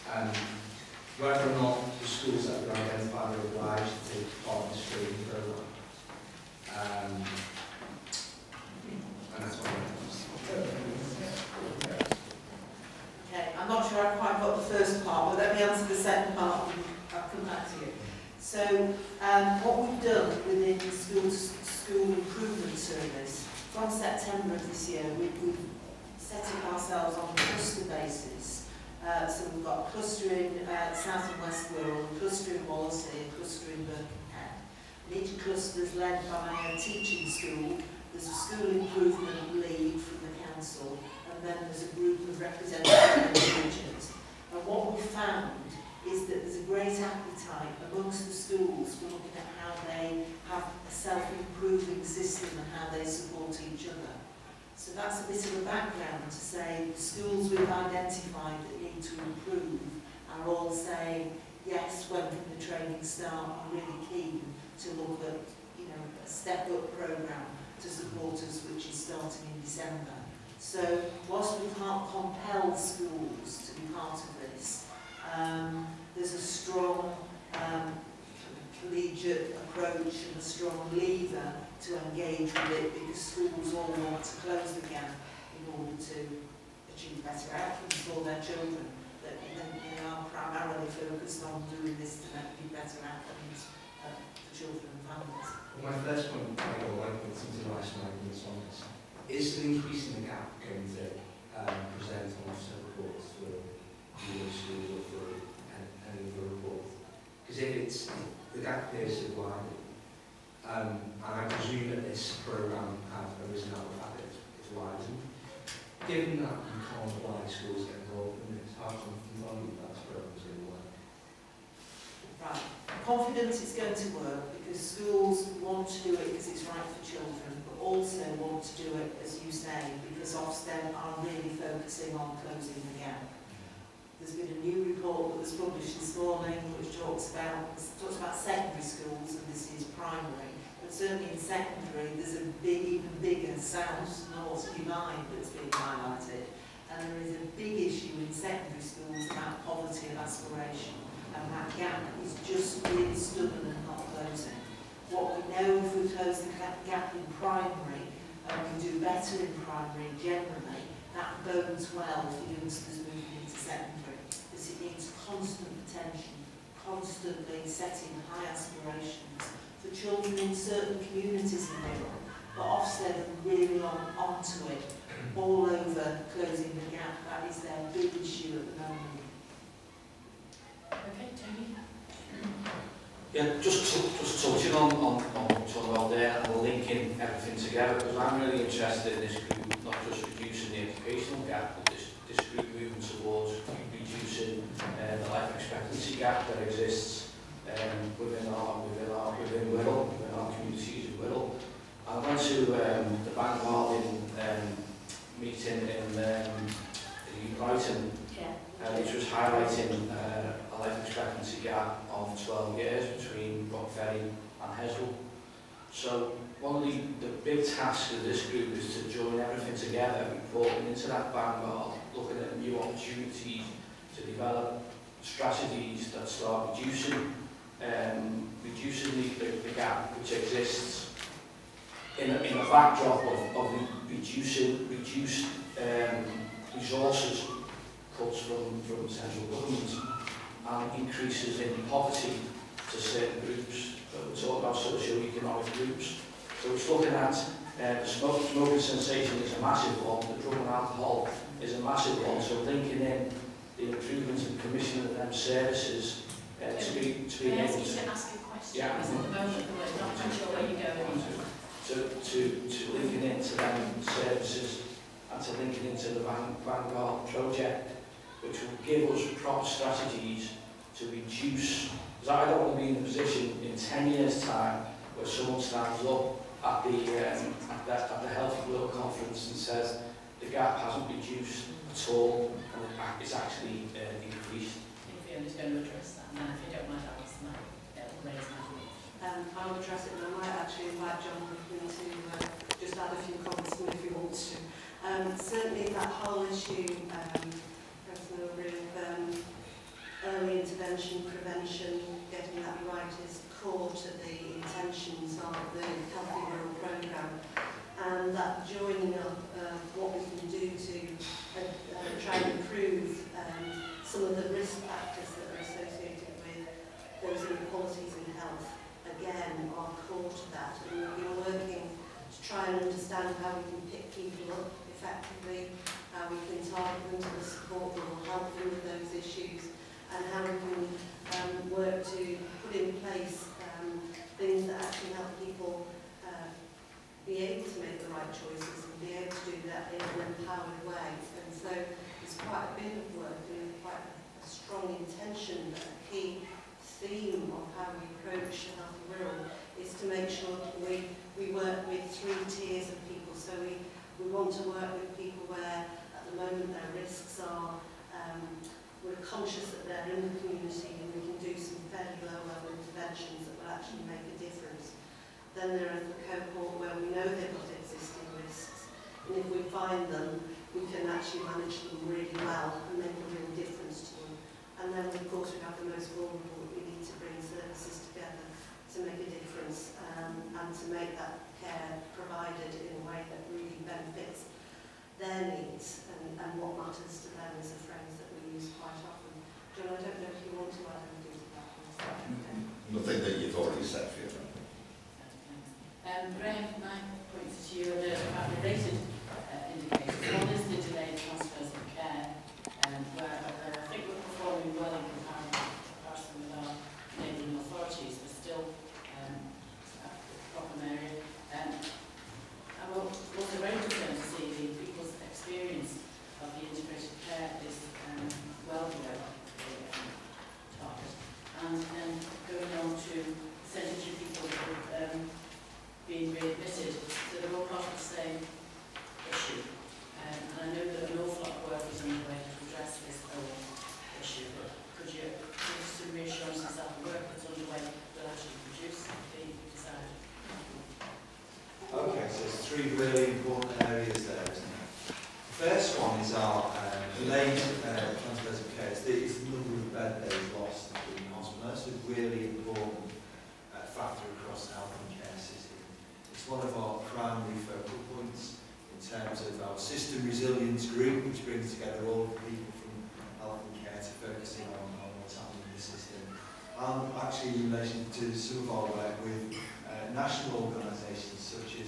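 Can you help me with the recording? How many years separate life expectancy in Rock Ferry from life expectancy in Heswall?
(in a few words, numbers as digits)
12 years.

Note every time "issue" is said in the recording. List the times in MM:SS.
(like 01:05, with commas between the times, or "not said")
02:27, 02:58, 04:56, 05:29.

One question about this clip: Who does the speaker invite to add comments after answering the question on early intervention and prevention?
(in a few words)
John Rickman.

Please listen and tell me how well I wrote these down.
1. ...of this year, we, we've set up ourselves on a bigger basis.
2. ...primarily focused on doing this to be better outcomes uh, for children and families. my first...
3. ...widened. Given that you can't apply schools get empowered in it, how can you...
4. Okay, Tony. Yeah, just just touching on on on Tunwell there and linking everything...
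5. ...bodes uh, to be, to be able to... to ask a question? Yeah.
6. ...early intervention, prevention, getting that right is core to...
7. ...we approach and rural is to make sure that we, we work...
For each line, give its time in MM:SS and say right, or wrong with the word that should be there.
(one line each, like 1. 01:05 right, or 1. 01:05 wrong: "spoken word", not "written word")
1. 00:24 wrong: "cluster", not "bigger"
2. 01:30 right
3. 01:54 wrong: "involved", not "empowered"
4. 03:00 right
5. 04:15 wrong: "services", not "bodes"
6. 05:00 right
7. 05:47 right.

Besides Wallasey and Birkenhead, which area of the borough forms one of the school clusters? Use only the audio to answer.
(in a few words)
South and West Wirral.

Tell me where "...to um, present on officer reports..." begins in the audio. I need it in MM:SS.
01:40.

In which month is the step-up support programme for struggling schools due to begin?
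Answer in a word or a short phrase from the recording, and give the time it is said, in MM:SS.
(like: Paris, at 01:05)
December, at 01:09.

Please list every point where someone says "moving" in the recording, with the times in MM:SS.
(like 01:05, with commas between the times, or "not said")
02:43, 03:12.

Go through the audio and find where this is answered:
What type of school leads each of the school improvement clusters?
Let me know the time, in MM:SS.
00:36.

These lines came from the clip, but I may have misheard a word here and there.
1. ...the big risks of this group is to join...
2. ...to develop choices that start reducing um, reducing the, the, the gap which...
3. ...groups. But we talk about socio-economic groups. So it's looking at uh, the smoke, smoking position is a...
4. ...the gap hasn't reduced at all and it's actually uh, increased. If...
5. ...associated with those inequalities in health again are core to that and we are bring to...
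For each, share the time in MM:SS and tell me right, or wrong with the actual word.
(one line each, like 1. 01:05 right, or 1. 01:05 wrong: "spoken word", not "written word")
1. 03:37 wrong: "tasks", not "risks"
2. 03:44 wrong: "strategies", not "choices"
3. 04:03 wrong: "sensation", not "position"
4. 04:40 right
5. 05:15 wrong: "working", not "bring".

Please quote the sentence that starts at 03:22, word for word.
I went to um, the Bank Martin um, meeting in um, in Brighton yeah.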